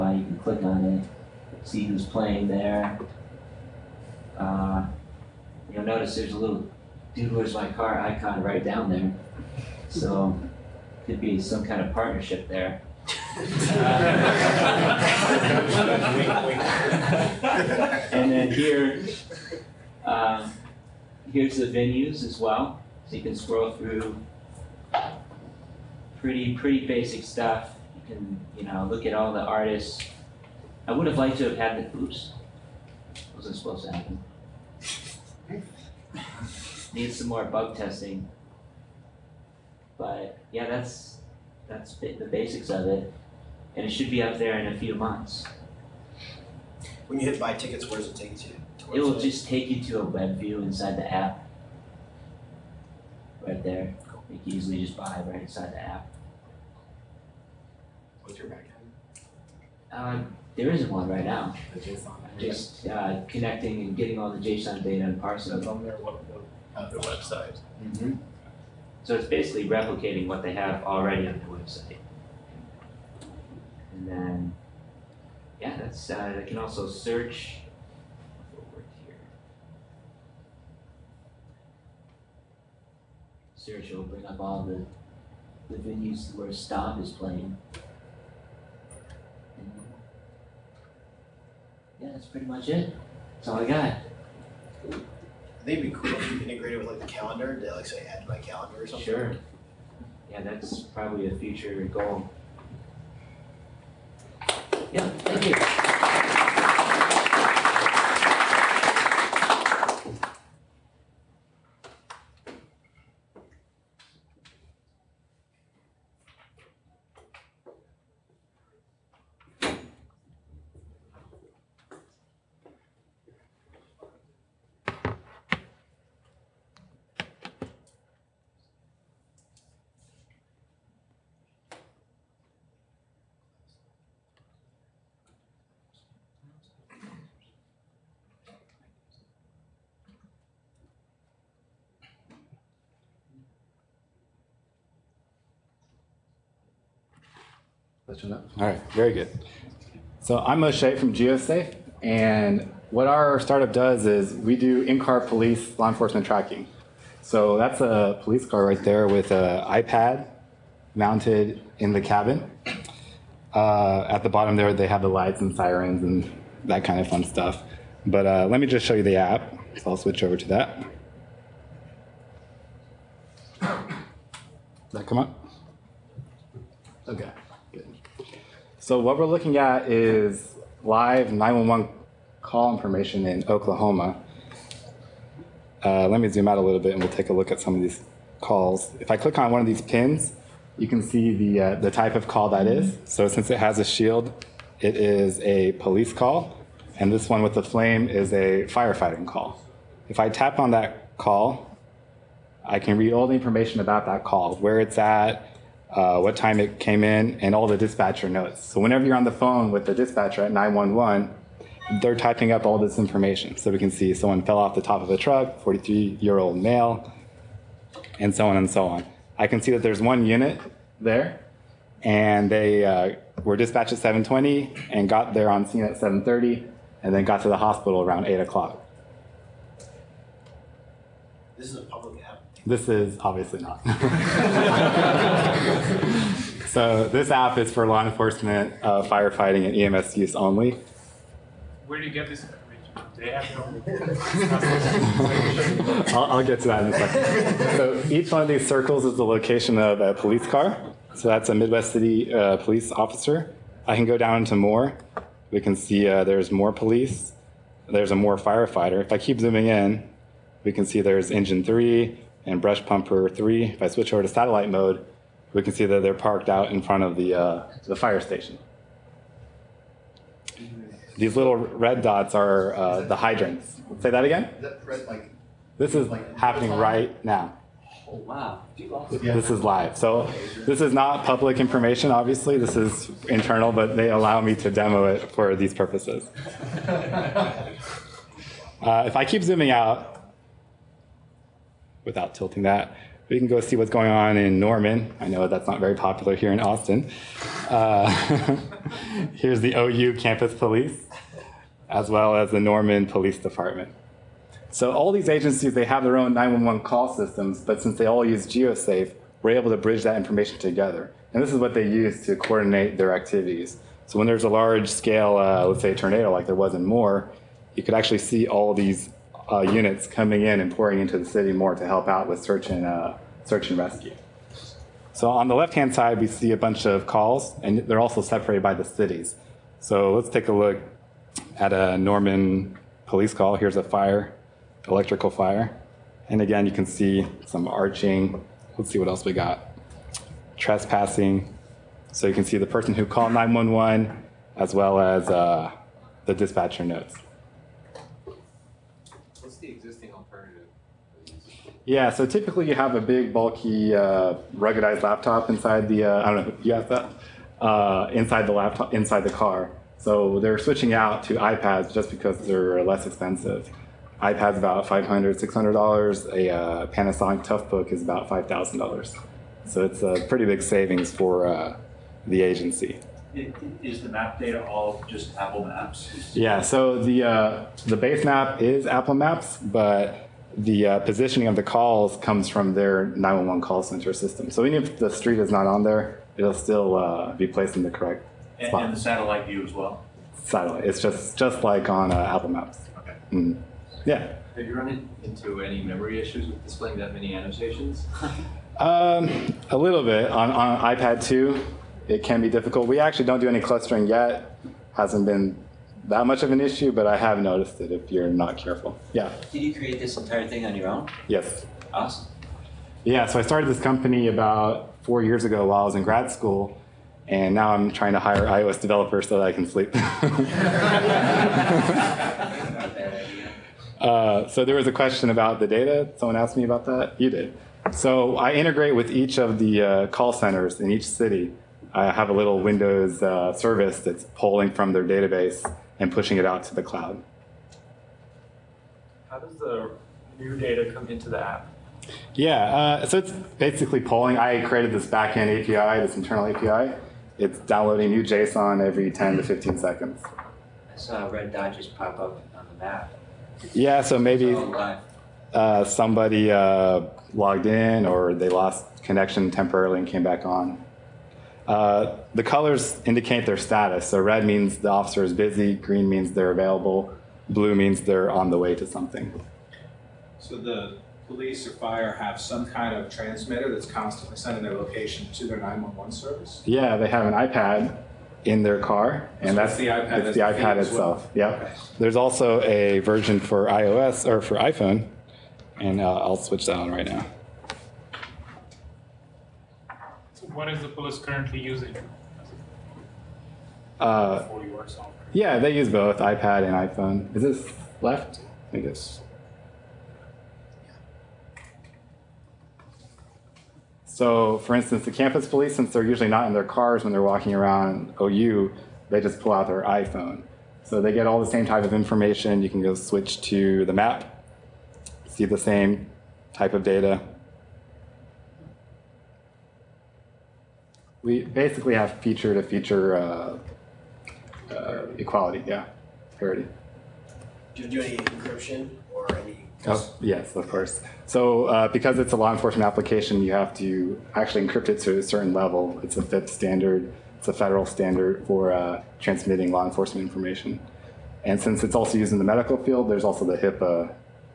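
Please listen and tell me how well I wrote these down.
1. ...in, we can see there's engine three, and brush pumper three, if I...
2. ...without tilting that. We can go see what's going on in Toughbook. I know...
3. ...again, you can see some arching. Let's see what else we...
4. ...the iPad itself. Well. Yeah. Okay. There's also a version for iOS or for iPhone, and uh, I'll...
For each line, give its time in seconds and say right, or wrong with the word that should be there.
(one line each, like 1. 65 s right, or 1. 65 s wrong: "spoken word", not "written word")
1. 259 s right
2. 292 s wrong: "Norman", not "Toughbook"
3. 336 s right
4. 480 s right.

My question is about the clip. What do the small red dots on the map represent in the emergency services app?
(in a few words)
Hydrants.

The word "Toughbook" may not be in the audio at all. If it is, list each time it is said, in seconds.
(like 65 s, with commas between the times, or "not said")
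367 s.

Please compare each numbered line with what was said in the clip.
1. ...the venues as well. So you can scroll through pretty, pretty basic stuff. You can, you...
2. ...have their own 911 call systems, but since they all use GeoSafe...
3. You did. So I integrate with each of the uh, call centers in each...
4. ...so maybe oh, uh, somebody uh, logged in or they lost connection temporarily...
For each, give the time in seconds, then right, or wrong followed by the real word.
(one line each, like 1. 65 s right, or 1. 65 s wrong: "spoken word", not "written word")
1. 21 s right
2. 305 s right
3. 427 s right
4. 454 s right.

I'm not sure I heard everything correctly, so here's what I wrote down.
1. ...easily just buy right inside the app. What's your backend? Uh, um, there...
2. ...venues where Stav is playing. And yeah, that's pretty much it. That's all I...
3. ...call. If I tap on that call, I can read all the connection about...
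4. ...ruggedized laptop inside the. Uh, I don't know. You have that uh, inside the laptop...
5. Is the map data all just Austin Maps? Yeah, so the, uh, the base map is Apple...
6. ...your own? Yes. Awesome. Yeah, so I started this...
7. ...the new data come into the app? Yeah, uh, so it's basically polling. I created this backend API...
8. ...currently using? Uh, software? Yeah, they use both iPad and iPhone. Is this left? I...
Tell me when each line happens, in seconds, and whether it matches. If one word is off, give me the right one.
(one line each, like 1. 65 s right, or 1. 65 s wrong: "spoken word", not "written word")
1. 54 s right
2. 85 s right
3. 199 s wrong: "information", not "connection"
4. 354 s right
5. 373 s wrong: "Apple", not "Austin"
6. 410 s right
7. 439 s right
8. 491 s right.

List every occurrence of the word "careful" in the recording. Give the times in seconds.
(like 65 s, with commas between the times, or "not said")
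408 s.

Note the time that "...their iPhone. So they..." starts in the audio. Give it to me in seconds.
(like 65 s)
509 s.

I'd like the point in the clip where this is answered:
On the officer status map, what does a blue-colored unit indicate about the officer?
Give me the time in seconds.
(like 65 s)
468 s.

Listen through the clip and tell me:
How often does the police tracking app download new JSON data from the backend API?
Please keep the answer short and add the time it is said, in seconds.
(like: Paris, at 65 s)
Every 10 to 15 seconds, at 448 s.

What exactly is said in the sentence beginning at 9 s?
So could be some kind of partnership there.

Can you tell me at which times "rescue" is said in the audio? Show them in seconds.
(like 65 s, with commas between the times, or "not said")
323 s.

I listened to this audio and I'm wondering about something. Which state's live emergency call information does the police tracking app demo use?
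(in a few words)
Oklahoma.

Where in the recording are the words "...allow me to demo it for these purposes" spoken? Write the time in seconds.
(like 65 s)
284 s.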